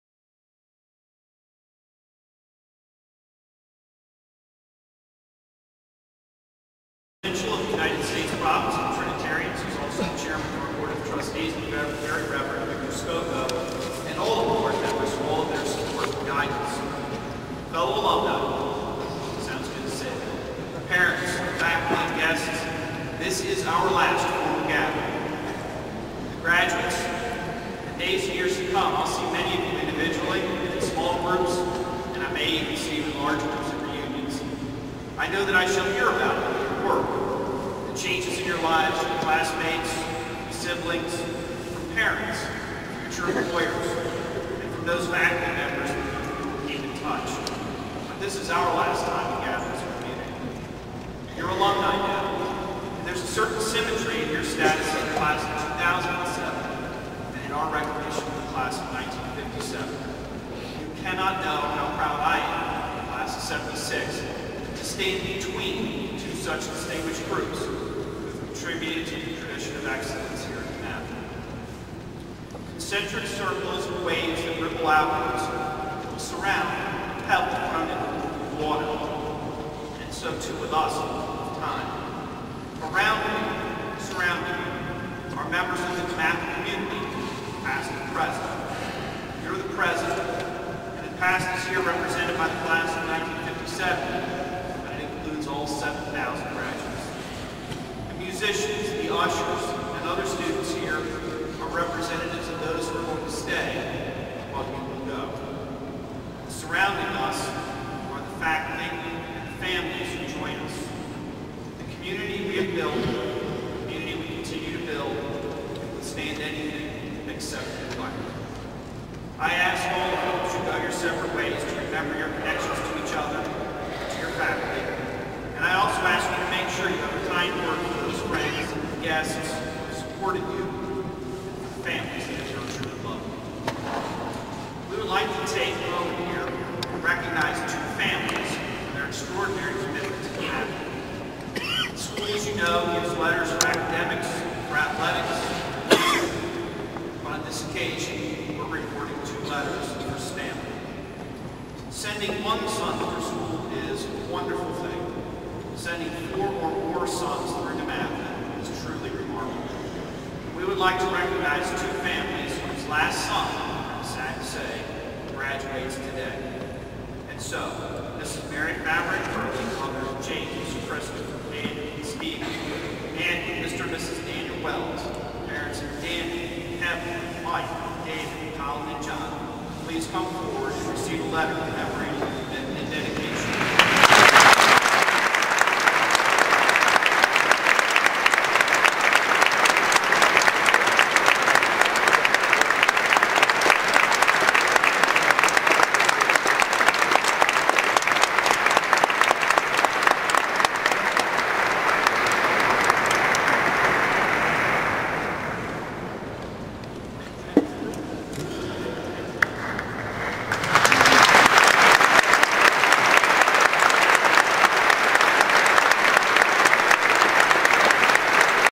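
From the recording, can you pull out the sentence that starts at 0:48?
But this is our last time gather as a community.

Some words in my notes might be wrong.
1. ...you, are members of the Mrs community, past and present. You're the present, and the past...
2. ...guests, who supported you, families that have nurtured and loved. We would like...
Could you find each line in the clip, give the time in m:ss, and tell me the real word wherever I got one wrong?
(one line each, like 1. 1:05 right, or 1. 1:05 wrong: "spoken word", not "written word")
1. 1:24 wrong: "Math", not "Mrs"
2. 2:09 right.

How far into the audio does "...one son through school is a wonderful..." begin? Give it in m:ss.
2:32.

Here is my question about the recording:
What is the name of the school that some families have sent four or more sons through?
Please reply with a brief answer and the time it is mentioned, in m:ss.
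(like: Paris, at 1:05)
DeMatha, at 2:37.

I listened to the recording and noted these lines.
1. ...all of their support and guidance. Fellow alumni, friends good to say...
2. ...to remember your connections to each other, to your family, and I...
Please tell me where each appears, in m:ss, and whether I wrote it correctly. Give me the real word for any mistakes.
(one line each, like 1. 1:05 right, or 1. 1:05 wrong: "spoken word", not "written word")
1. 0:15 wrong: "sounds", not "friends"
2. 2:01 right.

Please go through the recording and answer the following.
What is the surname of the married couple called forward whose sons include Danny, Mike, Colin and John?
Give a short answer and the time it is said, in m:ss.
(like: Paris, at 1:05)
Wells, at 2:54.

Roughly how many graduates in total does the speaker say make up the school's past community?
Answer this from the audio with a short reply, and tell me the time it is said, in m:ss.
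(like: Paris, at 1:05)
7,000, at 1:35.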